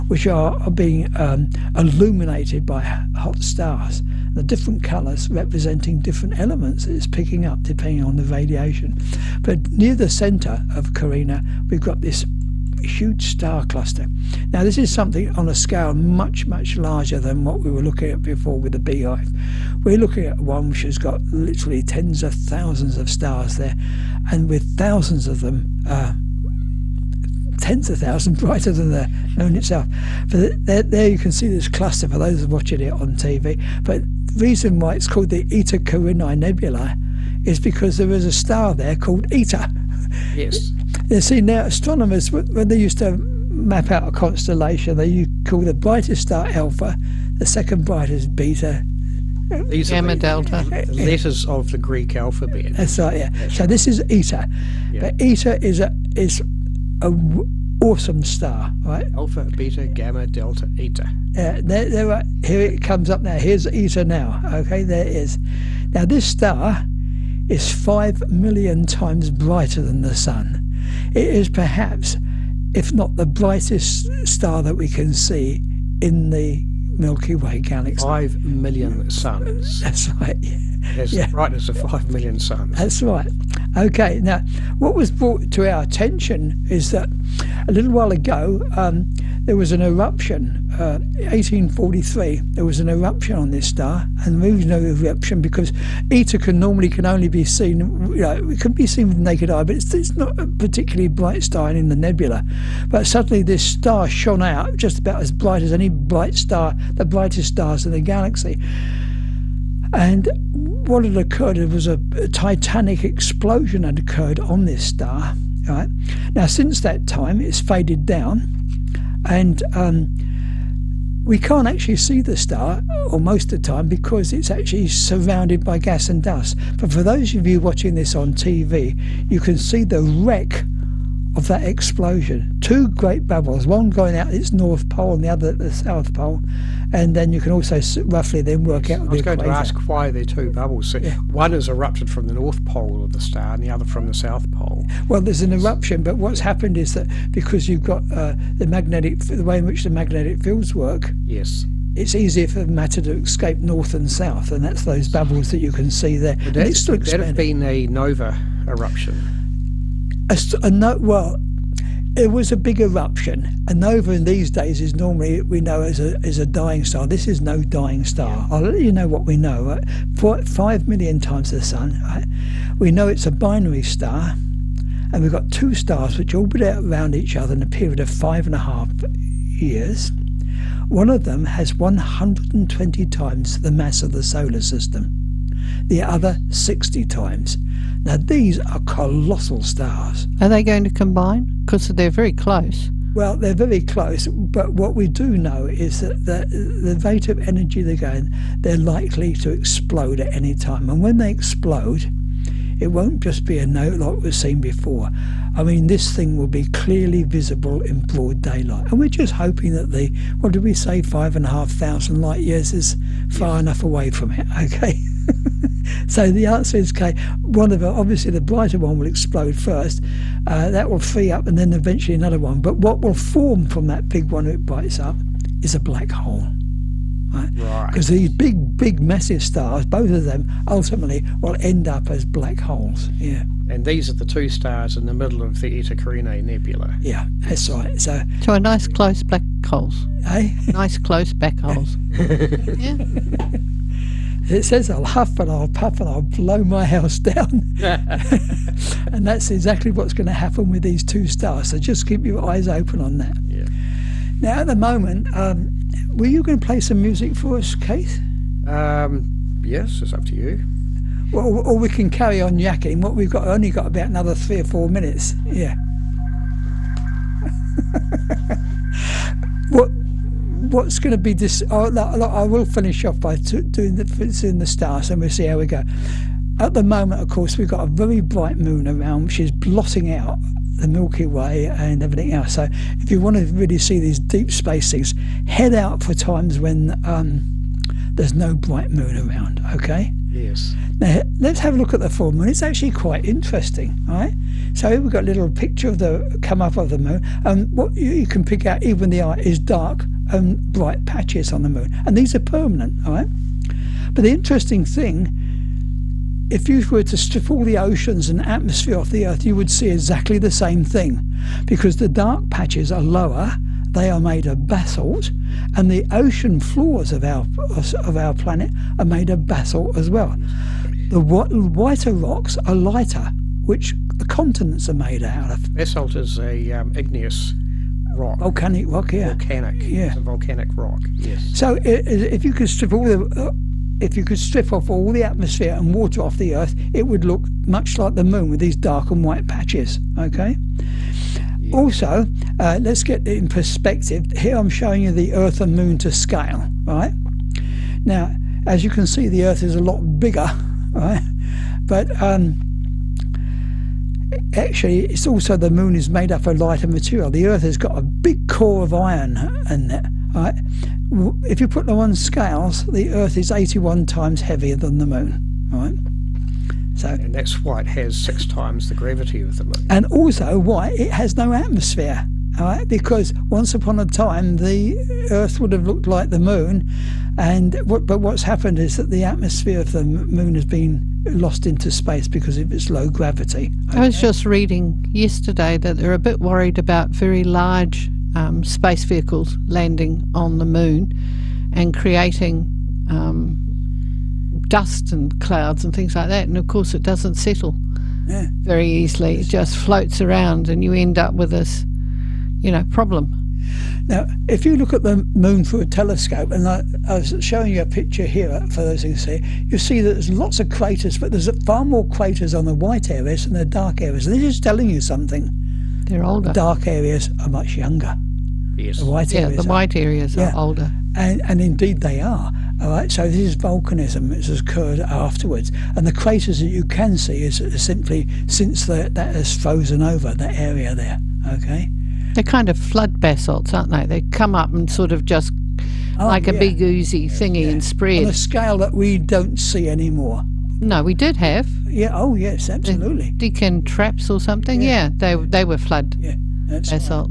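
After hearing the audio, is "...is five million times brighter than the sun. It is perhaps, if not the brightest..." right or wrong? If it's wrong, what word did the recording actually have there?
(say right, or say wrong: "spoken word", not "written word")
right.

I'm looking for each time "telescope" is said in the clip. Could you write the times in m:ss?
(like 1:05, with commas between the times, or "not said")
6:45.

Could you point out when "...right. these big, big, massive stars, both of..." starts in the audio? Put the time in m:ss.
3:48.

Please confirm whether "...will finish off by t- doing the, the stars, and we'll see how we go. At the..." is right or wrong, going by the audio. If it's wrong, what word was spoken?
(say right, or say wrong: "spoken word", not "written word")
right.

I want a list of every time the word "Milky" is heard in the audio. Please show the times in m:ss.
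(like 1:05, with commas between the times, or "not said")
1:16, 4:40.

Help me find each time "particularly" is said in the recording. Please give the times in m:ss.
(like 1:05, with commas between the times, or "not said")
1:40.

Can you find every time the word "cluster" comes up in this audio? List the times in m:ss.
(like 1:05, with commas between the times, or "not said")
0:13, 0:31.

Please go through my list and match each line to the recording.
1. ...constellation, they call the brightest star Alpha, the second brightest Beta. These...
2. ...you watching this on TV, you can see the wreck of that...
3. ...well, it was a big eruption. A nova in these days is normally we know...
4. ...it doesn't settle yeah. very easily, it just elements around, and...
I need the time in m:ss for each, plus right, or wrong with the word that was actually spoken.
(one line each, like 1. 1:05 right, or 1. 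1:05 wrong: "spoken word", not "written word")
1. 0:44 right
2. 2:07 right
3. 2:41 right
4. 6:36 wrong: "floats", not "elements".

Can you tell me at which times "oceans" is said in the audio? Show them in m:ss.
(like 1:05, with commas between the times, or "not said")
5:07, 5:16.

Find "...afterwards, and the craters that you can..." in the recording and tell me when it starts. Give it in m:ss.
7:05.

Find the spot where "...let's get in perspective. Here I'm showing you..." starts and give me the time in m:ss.
5:42.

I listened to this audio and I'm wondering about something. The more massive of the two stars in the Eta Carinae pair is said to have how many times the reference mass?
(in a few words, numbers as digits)
120.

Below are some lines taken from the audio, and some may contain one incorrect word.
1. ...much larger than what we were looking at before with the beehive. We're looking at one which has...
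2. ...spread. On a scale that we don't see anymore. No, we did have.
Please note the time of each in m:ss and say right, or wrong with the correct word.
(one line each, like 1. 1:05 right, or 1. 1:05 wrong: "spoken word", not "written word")
1. 0:16 right
2. 7:17 right.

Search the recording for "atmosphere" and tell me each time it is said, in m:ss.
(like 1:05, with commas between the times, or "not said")
5:08, 5:35, 6:11, 6:19.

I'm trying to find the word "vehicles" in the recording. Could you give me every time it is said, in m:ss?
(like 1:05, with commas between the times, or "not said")
6:29.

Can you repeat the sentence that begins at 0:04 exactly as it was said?
The different colours representing different elements that it's picking up depending on the radiation.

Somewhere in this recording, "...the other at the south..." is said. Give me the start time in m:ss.
2:15.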